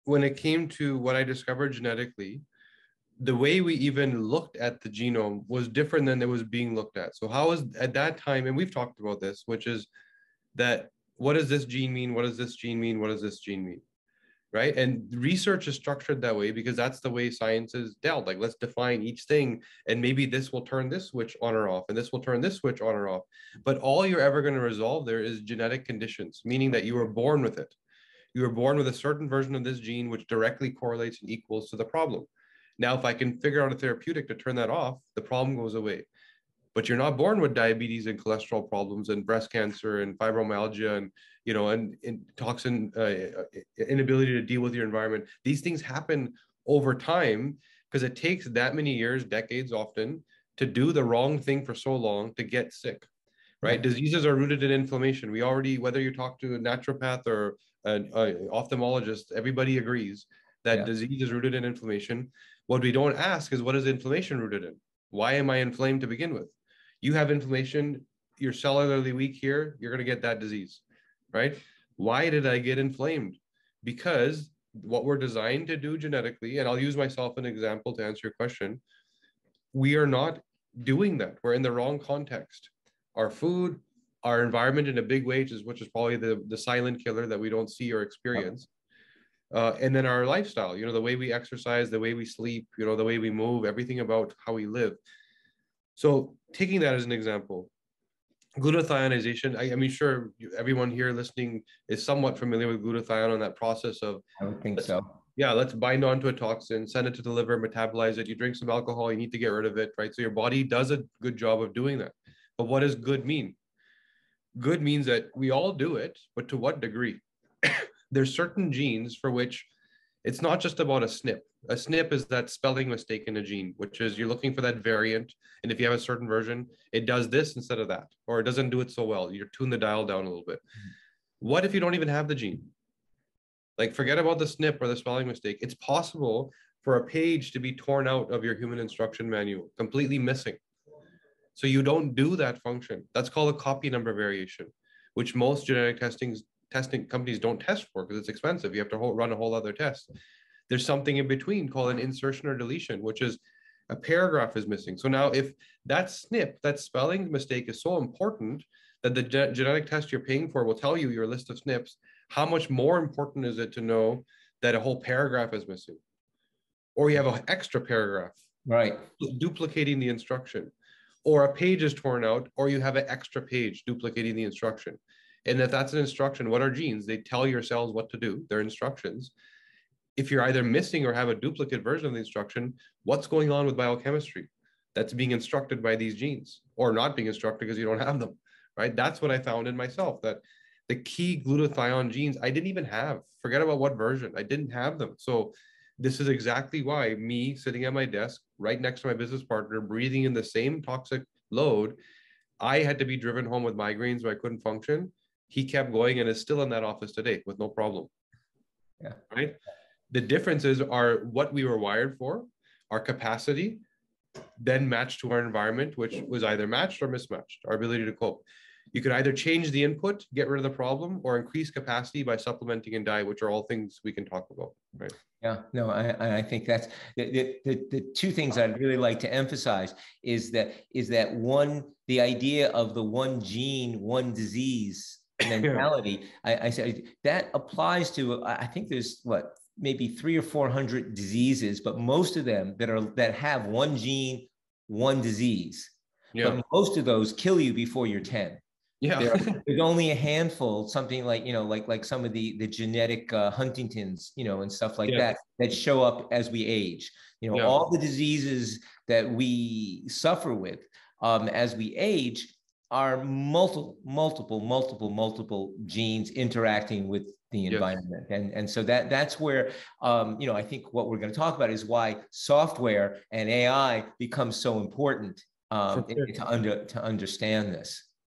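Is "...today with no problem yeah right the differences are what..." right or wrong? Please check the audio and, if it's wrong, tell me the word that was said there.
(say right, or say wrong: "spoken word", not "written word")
right.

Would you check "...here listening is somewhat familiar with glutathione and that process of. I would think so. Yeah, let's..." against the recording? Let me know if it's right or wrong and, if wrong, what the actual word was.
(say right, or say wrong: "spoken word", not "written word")
right.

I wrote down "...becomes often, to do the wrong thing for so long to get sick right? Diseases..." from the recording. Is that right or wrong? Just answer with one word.
wrong.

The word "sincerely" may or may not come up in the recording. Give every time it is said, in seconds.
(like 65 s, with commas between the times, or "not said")
not said.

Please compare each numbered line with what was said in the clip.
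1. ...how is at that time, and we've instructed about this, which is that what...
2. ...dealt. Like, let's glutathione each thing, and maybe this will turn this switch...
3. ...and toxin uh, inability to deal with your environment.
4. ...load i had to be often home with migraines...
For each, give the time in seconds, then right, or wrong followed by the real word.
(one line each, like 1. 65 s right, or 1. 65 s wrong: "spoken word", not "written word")
1. 7 s wrong: "talked", not "instructed"
2. 18 s wrong: "define", not "glutathione"
3. 42 s right
4. 201 s wrong: "driven", not "often".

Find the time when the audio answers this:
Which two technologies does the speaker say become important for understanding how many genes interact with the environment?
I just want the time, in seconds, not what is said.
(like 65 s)
272 s.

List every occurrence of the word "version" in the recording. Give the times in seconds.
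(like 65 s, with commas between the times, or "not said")
29 s, 126 s, 181 s, 193 s.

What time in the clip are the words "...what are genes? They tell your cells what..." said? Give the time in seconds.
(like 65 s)
176 s.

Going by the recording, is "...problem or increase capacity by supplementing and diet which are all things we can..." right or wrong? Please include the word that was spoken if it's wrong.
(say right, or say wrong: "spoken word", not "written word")
right.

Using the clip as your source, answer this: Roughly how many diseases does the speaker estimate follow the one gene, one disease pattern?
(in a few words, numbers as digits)
300 or 400.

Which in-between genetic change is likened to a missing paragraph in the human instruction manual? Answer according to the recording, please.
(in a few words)
Insertion or deletion.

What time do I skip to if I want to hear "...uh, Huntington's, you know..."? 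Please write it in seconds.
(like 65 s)
253 s.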